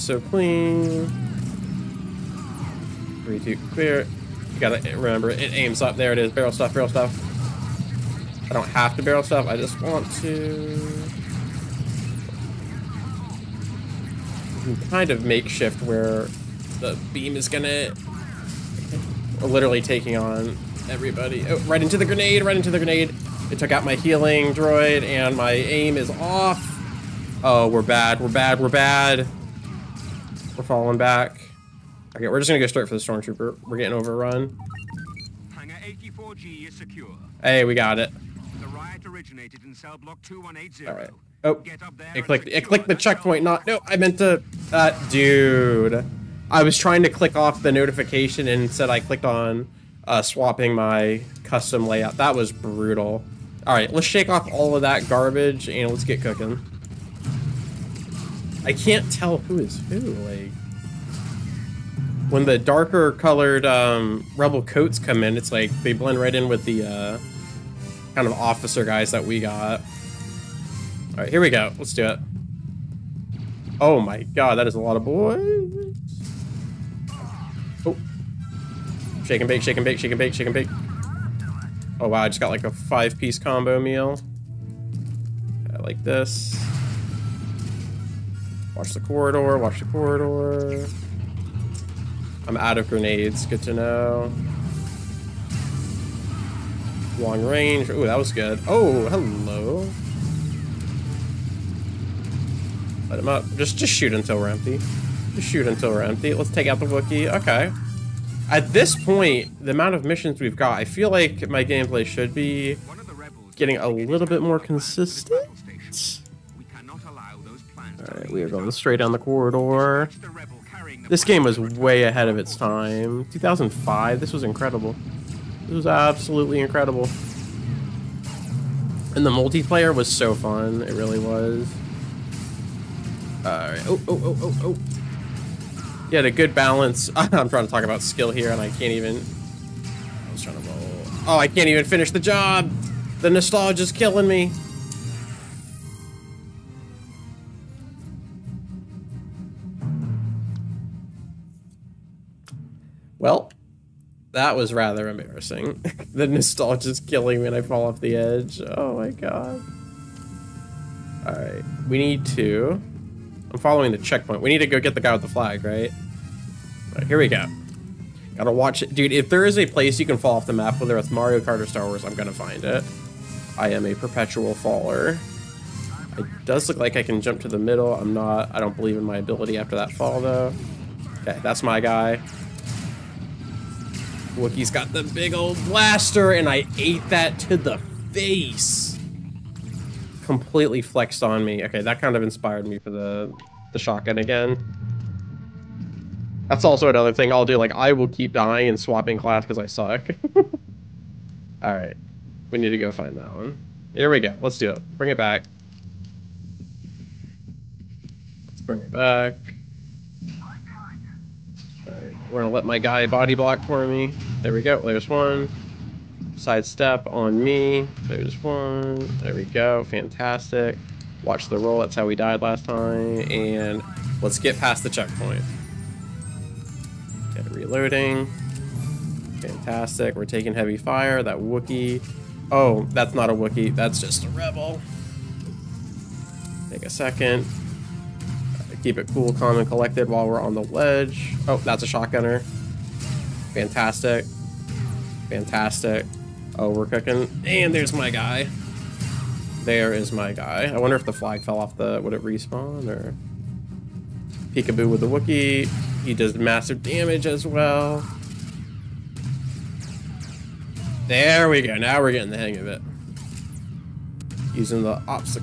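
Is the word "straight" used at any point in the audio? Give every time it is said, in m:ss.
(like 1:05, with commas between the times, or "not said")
0:32, 1:58.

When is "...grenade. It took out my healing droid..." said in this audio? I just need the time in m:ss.
0:22.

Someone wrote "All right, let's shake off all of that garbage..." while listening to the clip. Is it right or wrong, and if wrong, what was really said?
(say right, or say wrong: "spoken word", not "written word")
right.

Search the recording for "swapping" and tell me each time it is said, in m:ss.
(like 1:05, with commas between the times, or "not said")
0:50, 3:18.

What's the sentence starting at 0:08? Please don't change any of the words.
I don't have to barrel stuff.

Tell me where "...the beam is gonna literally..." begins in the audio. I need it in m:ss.
0:16.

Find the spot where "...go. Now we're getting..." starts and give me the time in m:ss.
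4:21.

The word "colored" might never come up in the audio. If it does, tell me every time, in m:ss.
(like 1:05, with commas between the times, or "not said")
1:03.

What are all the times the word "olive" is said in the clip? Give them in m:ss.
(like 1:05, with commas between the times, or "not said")
not said.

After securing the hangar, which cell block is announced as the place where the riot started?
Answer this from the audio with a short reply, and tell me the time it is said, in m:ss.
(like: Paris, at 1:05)
2180, at 0:40.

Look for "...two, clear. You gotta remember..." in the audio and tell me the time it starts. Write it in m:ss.
0:03.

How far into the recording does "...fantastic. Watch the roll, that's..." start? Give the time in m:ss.
3:39.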